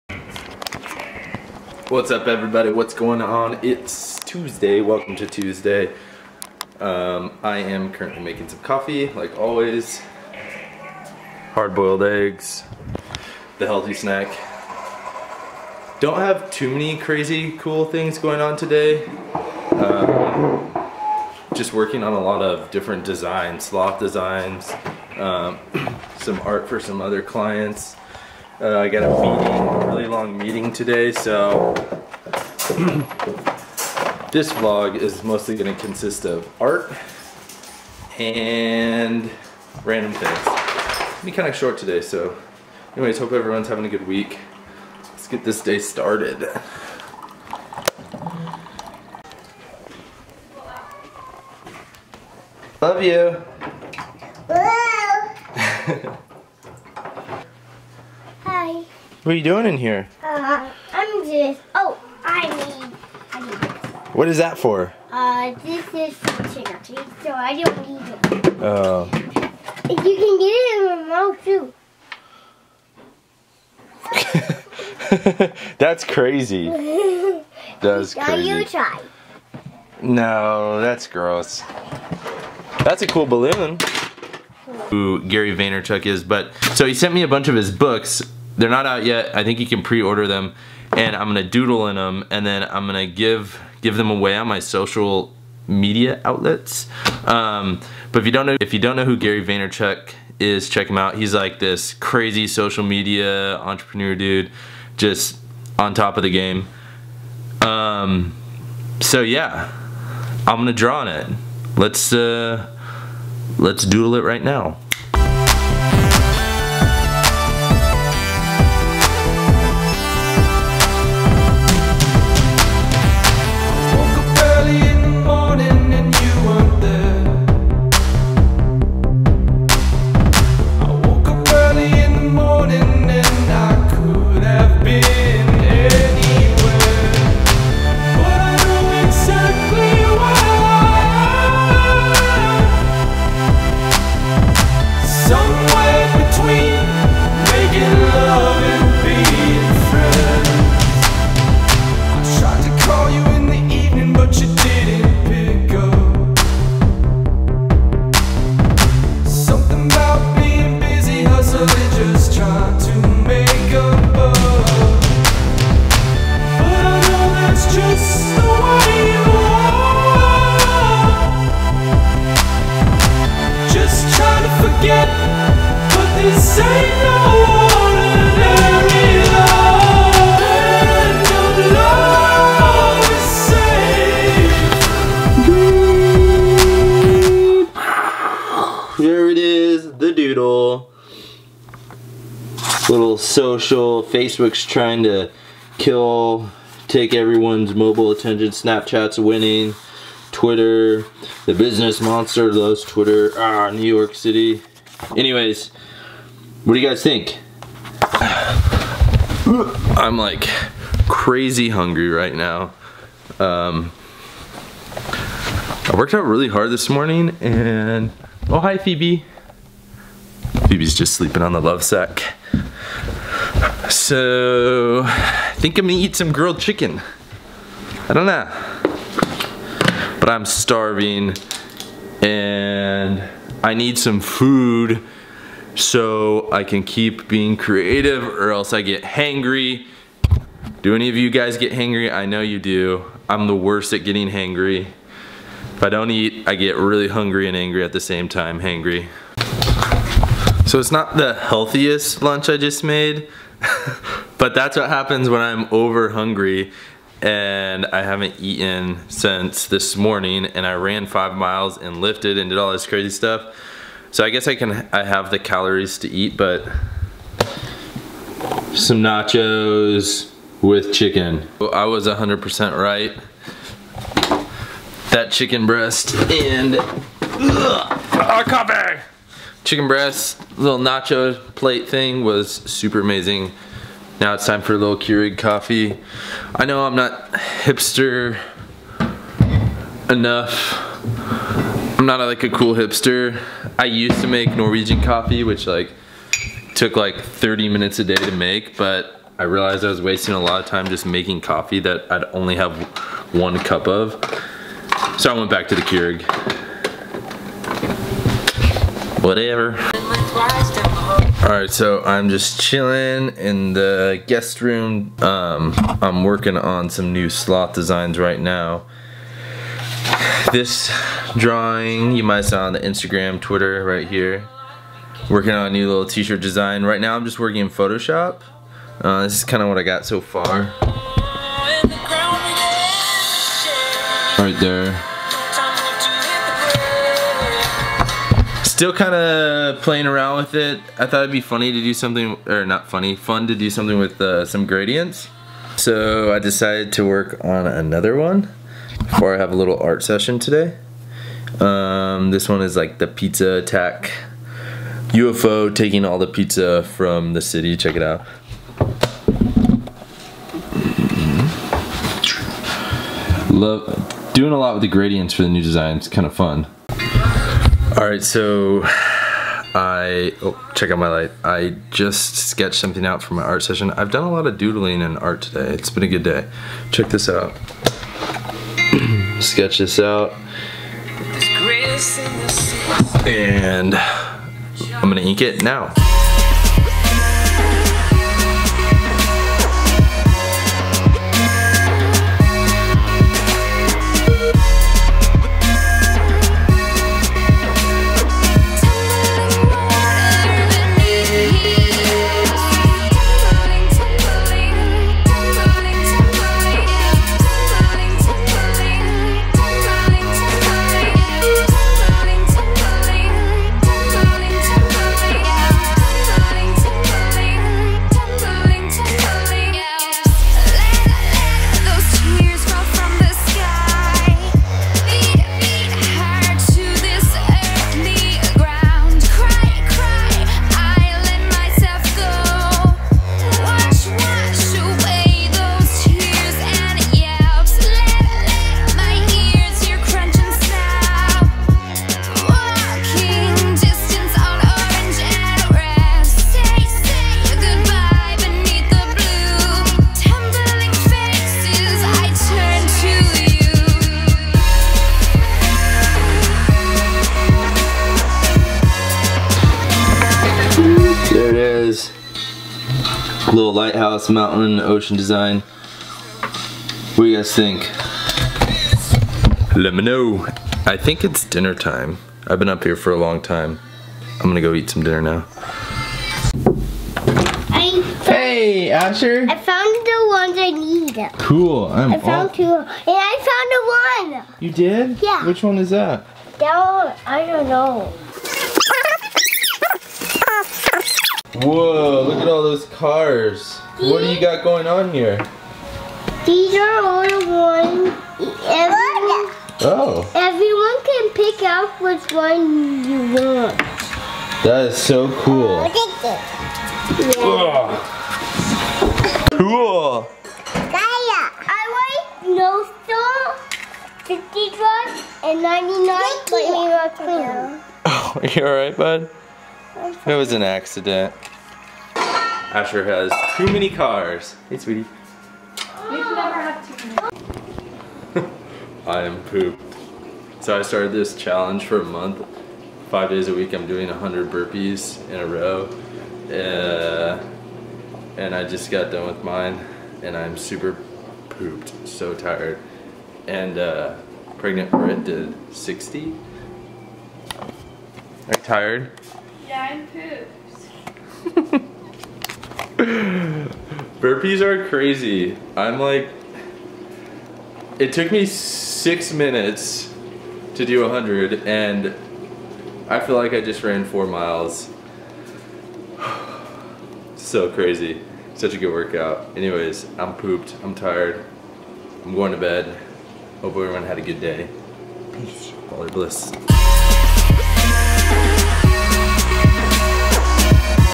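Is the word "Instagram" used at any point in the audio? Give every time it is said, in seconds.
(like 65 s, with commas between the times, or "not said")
322 s.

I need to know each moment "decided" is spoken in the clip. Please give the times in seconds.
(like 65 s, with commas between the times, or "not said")
346 s.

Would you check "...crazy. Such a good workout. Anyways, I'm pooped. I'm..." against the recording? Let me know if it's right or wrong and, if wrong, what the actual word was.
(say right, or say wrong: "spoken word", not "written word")
right.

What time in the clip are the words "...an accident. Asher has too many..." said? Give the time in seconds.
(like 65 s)
520 s.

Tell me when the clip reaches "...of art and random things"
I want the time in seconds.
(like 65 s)
36 s.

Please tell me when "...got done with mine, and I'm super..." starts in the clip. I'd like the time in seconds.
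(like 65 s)
538 s.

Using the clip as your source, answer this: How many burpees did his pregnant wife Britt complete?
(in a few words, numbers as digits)
60.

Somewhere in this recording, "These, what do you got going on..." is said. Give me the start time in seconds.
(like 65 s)
493 s.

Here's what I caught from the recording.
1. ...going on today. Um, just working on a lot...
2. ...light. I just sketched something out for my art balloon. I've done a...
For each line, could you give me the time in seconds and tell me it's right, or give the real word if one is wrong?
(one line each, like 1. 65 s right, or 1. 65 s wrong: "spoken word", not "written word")
1. 18 s right
2. 371 s wrong: "session", not "balloon".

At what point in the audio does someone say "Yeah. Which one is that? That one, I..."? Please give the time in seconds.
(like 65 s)
485 s.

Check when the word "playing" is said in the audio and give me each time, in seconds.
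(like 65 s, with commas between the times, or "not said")
339 s.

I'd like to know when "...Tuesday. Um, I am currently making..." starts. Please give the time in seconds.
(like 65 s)
5 s.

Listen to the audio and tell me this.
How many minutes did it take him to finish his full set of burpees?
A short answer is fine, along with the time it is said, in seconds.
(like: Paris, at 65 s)
6, at 558 s.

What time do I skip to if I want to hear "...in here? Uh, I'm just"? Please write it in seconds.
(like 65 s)
59 s.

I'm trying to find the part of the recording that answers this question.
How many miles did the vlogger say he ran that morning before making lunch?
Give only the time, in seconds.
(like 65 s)
261 s.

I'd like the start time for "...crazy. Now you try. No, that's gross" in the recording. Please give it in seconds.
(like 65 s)
78 s.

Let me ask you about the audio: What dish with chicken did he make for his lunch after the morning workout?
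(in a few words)
Nachos.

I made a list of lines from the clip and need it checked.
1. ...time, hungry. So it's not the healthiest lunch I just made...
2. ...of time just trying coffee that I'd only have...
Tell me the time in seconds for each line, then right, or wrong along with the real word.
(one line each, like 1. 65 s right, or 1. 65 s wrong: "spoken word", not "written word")
1. 248 s wrong: "hangry", not "hungry"
2. 300 s wrong: "making", not "trying".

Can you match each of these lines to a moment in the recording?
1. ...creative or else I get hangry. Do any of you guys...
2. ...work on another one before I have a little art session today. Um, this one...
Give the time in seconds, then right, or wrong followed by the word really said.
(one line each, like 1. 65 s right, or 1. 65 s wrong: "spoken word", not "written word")
1. 237 s right
2. 347 s right.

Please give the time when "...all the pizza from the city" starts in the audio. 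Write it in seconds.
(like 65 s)
356 s.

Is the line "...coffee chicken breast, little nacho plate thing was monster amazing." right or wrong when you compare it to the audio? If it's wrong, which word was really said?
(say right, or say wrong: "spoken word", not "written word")
wrong: "super", not "monster".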